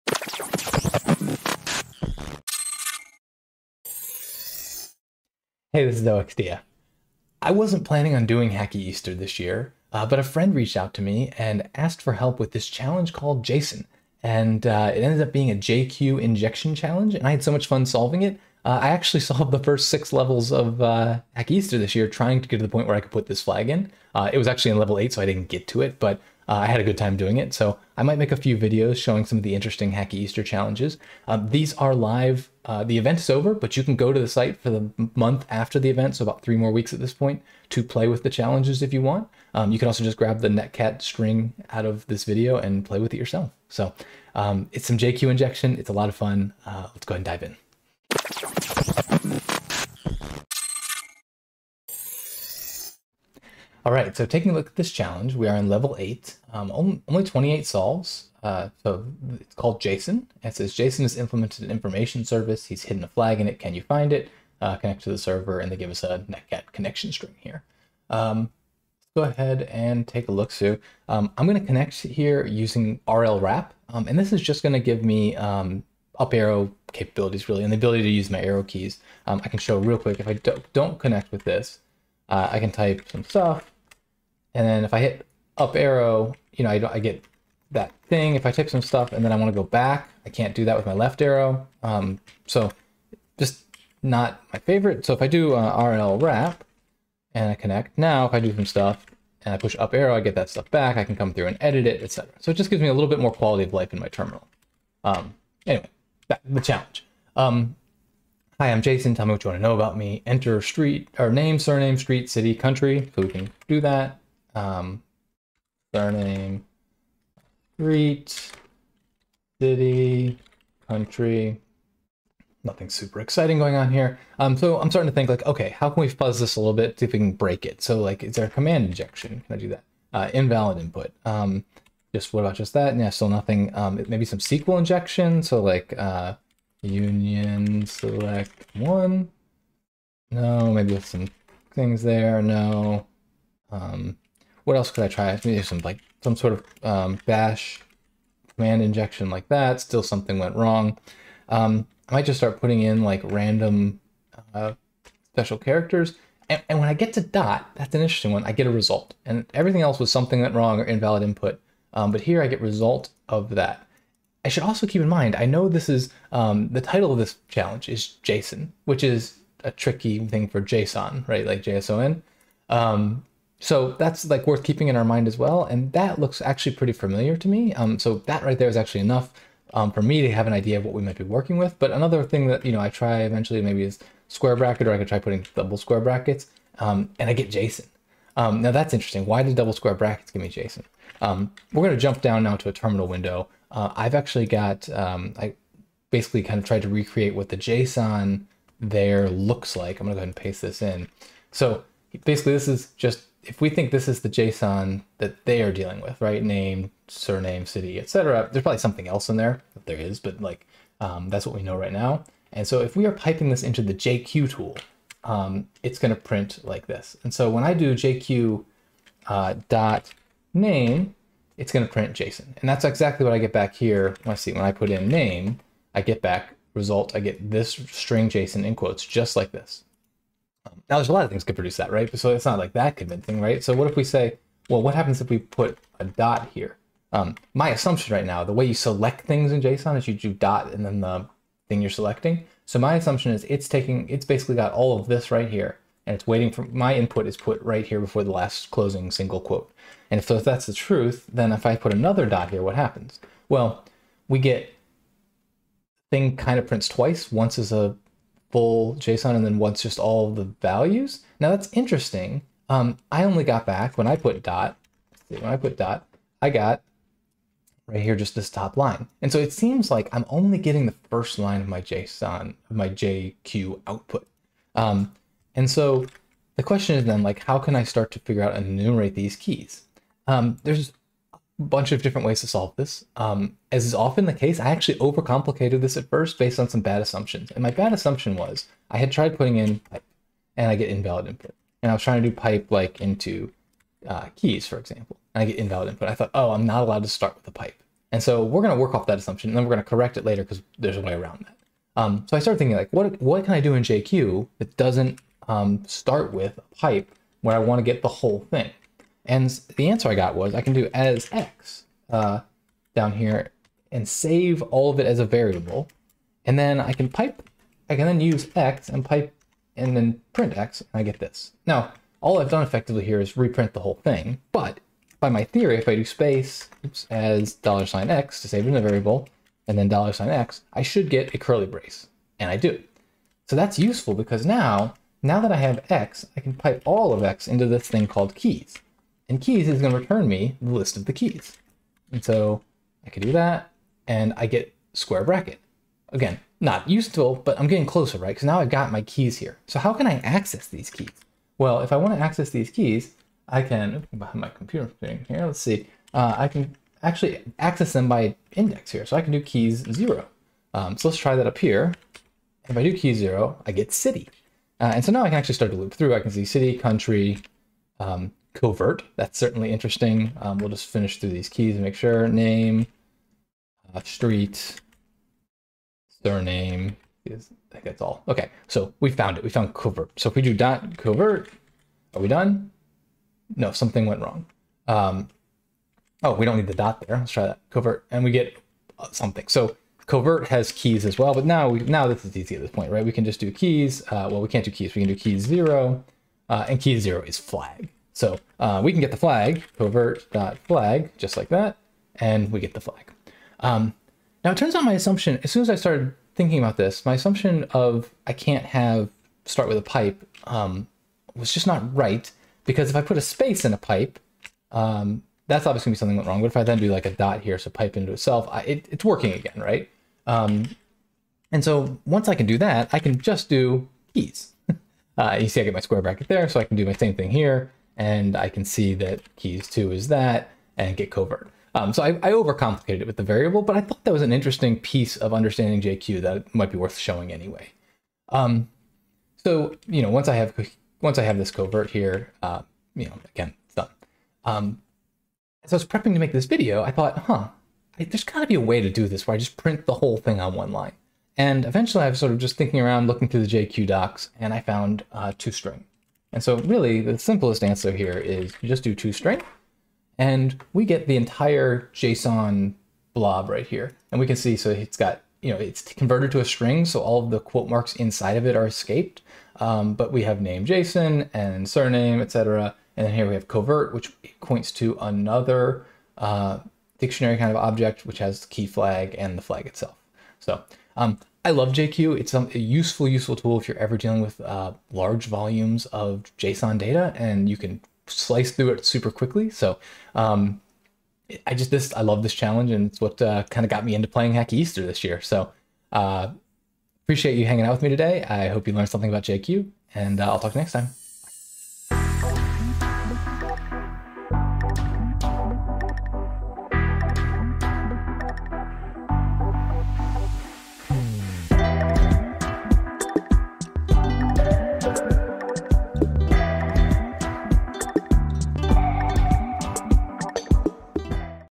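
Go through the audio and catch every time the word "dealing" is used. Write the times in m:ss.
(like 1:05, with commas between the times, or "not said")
3:25, 8:03.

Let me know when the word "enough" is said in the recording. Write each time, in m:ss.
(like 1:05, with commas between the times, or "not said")
2:59.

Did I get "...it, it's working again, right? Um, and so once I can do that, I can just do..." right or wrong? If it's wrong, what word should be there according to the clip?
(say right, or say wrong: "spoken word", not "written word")
right.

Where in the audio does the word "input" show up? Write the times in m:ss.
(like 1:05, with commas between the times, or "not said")
2:10, 2:41, 4:06, 4:51, 4:55.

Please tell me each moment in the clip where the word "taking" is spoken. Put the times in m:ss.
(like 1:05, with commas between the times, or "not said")
0:54, 4:03.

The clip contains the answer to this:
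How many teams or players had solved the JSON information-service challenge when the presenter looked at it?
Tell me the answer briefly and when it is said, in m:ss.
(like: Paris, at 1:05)
28, at 0:57.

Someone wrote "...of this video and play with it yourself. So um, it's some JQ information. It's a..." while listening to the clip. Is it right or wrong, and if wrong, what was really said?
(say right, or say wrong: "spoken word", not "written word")
wrong: "injection", not "information".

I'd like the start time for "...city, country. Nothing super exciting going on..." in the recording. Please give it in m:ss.
1:59.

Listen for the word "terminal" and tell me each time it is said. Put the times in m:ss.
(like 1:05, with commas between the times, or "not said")
1:44, 3:12.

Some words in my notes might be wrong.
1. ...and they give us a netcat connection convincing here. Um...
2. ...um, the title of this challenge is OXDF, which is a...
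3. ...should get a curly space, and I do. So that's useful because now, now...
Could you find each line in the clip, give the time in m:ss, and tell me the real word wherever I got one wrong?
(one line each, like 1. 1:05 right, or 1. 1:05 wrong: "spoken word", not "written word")
1. 1:05 wrong: "string", not "convincing"
2. 2:46 wrong: "JSON", not "OXDF"
3. 5:30 wrong: "brace", not "space".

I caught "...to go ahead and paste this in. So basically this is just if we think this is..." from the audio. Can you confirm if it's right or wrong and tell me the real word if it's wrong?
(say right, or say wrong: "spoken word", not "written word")
right.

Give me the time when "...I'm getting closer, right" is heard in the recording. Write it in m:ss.
5:47.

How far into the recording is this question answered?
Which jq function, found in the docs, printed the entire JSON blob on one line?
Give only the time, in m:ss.
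7:38.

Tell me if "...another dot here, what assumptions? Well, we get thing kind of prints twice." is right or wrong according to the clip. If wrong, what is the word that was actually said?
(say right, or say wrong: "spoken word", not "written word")
wrong: "happens", not "assumptions".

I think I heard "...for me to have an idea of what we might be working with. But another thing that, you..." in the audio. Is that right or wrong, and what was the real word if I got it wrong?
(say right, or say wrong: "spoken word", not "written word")
right.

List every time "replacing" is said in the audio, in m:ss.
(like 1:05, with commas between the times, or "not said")
not said.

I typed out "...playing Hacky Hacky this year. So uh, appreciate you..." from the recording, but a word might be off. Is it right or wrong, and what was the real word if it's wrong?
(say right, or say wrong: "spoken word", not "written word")
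wrong: "Easter", not "Hacky".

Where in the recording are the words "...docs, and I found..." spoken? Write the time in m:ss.
7:33.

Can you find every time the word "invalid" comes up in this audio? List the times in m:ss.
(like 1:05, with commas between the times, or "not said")
2:10, 2:40, 4:50, 4:55.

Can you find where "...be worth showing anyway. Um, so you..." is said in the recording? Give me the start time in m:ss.
7:16.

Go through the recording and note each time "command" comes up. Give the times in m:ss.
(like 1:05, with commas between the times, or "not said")
2:08, 2:28.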